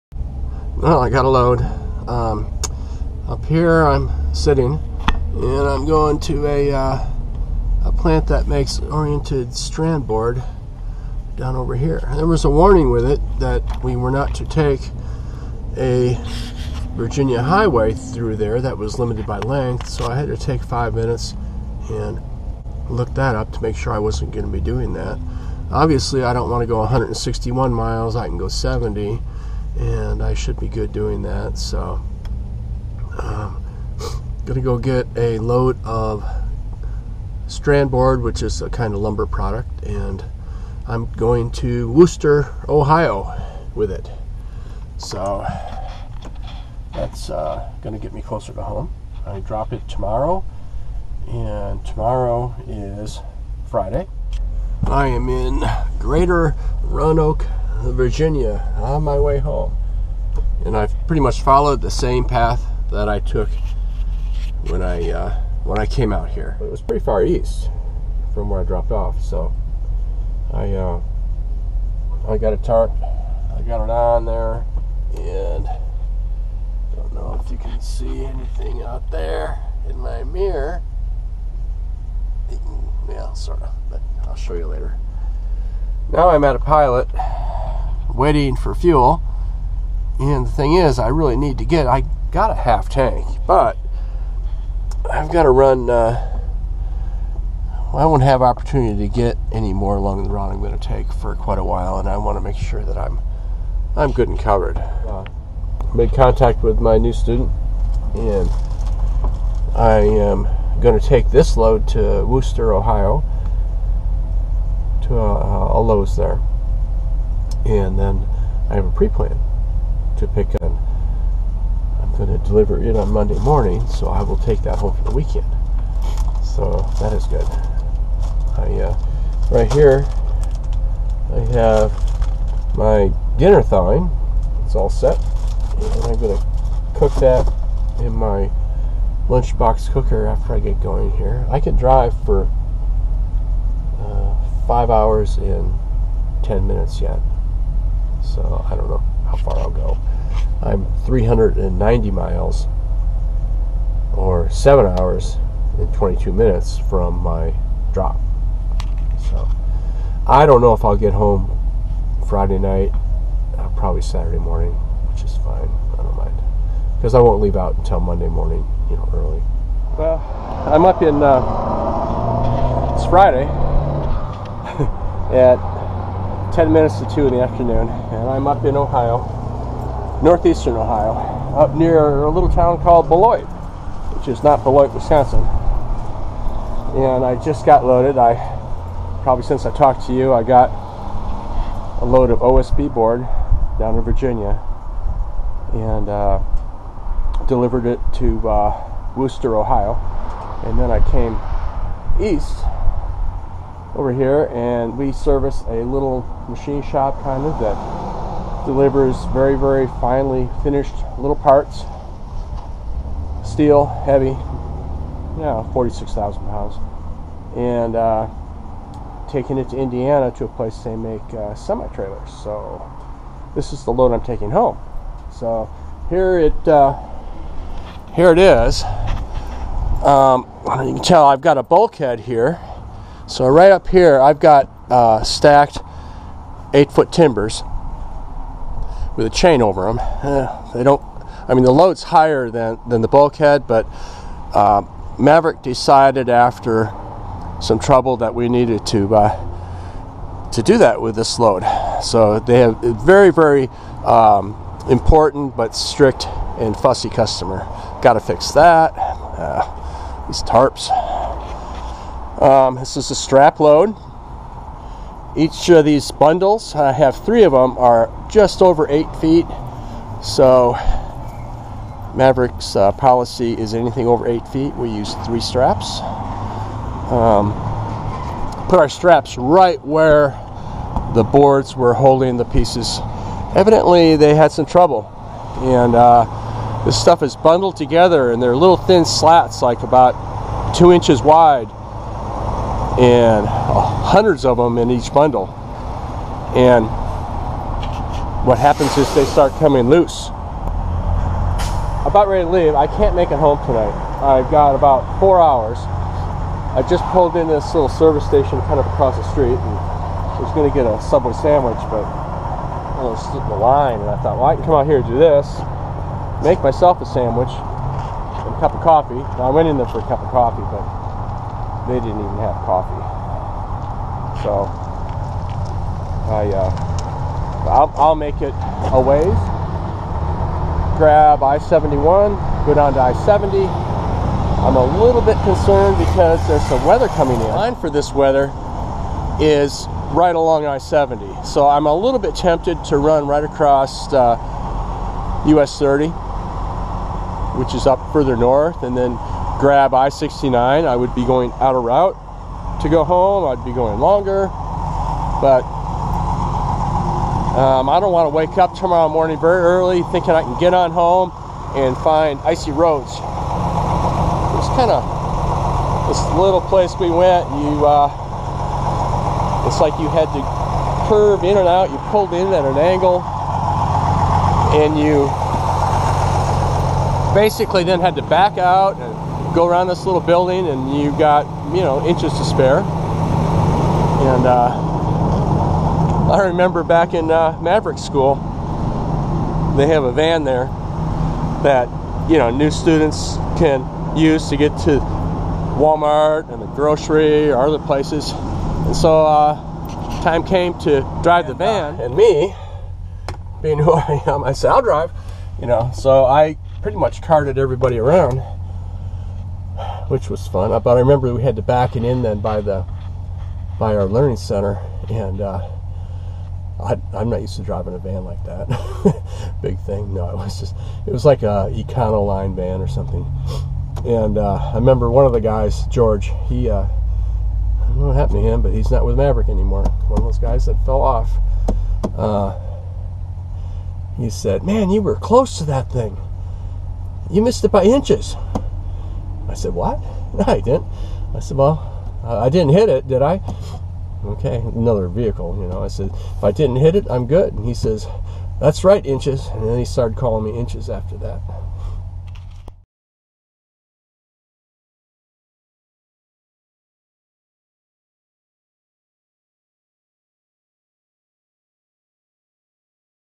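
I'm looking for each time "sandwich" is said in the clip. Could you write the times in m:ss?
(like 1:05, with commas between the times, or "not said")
5:11, 5:17.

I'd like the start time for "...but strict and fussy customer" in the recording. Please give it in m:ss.
4:15.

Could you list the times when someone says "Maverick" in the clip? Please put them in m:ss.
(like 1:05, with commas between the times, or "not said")
4:05, 4:32, 6:27, 7:09.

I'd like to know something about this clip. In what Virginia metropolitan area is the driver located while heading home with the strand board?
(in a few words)
Greater Roanoke.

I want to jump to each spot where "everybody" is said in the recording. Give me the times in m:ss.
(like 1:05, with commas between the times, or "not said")
6:47.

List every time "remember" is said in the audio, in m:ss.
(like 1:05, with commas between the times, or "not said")
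6:26, 6:50, 7:04.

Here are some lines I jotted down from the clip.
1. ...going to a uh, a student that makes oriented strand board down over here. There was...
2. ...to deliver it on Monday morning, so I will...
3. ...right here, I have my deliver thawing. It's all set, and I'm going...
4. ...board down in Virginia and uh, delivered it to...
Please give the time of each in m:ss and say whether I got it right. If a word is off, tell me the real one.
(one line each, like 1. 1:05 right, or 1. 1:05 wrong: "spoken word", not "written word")
1. 0:05 wrong: "plant", not "student"
2. 2:02 right
3. 2:09 wrong: "dinner", not "deliver"
4. 3:12 right.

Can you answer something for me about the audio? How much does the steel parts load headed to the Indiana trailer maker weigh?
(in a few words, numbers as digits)
46,000 pounds.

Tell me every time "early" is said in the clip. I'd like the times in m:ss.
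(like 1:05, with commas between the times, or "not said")
2:49, 5:59.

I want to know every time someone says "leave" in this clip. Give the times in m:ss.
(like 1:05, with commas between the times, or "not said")
2:47, 5:02.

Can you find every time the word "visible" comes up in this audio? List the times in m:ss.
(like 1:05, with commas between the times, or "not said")
not said.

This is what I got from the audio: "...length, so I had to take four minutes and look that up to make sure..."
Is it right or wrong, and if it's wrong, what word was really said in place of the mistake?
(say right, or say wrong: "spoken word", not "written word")
wrong: "five", not "four".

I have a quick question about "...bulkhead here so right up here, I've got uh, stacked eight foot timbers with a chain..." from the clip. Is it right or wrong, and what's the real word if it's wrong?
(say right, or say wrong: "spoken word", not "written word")
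right.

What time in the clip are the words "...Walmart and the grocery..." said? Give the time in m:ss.
6:35.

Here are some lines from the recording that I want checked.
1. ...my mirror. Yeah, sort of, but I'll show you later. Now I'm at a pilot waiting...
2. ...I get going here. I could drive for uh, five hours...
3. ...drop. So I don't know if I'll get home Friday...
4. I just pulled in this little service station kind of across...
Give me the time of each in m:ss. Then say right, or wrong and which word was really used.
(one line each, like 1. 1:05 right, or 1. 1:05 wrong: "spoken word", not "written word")
1. 1:19 right
2. 2:20 right
3. 2:37 right
4. 5:05 right.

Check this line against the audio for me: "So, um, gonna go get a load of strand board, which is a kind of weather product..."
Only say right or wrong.
wrong.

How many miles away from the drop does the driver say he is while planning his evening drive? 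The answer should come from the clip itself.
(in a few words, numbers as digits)
390.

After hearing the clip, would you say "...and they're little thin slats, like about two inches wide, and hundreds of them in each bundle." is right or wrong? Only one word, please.
right.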